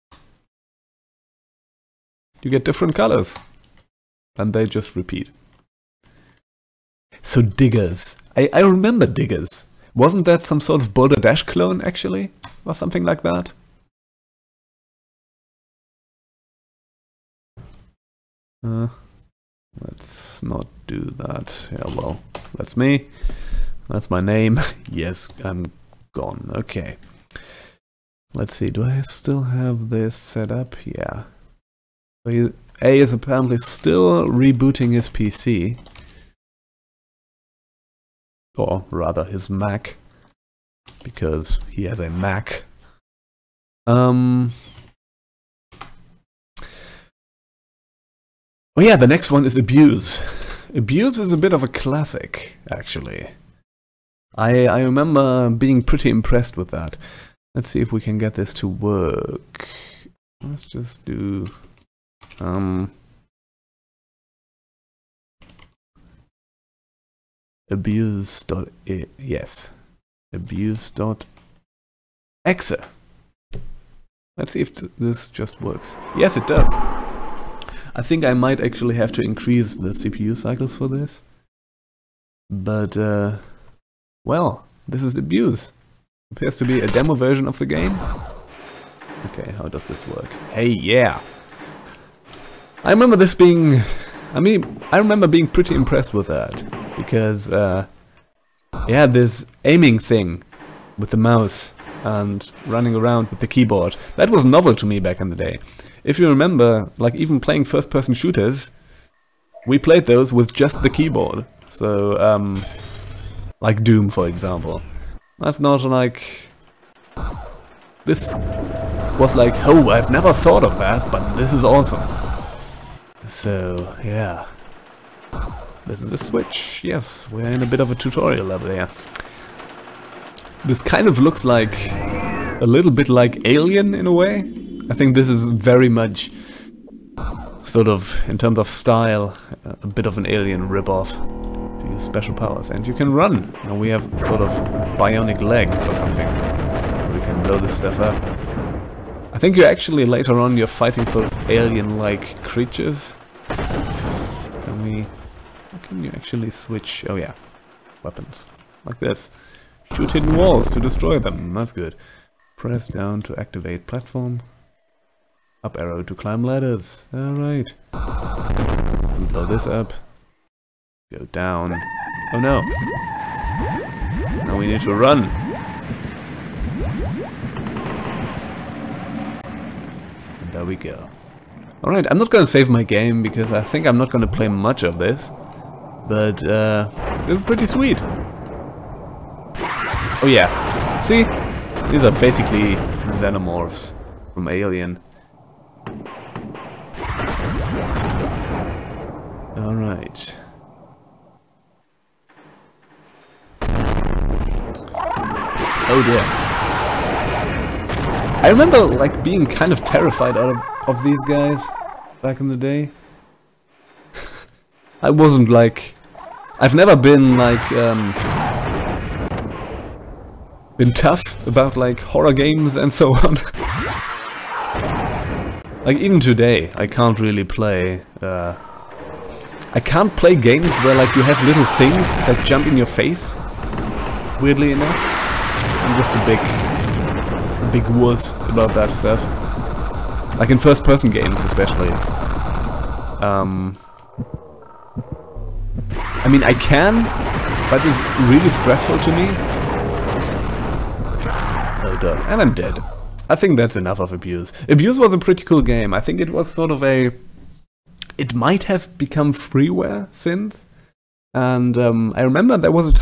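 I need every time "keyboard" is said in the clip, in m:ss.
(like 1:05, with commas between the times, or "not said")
1:43, 1:50.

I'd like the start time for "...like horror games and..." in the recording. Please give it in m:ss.
3:41.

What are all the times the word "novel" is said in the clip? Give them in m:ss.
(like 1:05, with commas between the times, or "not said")
1:44.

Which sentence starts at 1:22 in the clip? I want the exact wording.
But, uh, well, this is abuse.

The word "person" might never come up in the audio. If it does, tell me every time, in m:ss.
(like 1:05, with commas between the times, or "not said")
1:47, 4:00.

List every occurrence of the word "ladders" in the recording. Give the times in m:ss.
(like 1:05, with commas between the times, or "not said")
2:46.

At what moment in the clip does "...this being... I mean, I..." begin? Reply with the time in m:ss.
1:33.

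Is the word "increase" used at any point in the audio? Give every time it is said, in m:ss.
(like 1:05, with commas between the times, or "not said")
1:19.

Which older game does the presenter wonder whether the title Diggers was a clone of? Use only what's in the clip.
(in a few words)
Boulder Dash.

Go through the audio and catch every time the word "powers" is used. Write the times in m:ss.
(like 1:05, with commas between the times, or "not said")
2:22.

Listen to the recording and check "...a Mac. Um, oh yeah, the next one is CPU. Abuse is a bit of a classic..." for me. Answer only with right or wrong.
wrong.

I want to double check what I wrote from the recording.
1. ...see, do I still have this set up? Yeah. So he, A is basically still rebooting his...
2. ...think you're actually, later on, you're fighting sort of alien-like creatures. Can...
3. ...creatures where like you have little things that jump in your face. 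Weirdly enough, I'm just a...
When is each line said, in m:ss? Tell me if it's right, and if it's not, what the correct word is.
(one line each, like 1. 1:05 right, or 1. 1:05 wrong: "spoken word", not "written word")
1. 0:28 wrong: "apparently", not "basically"
2. 2:29 right
3. 3:50 wrong: "games", not "creatures".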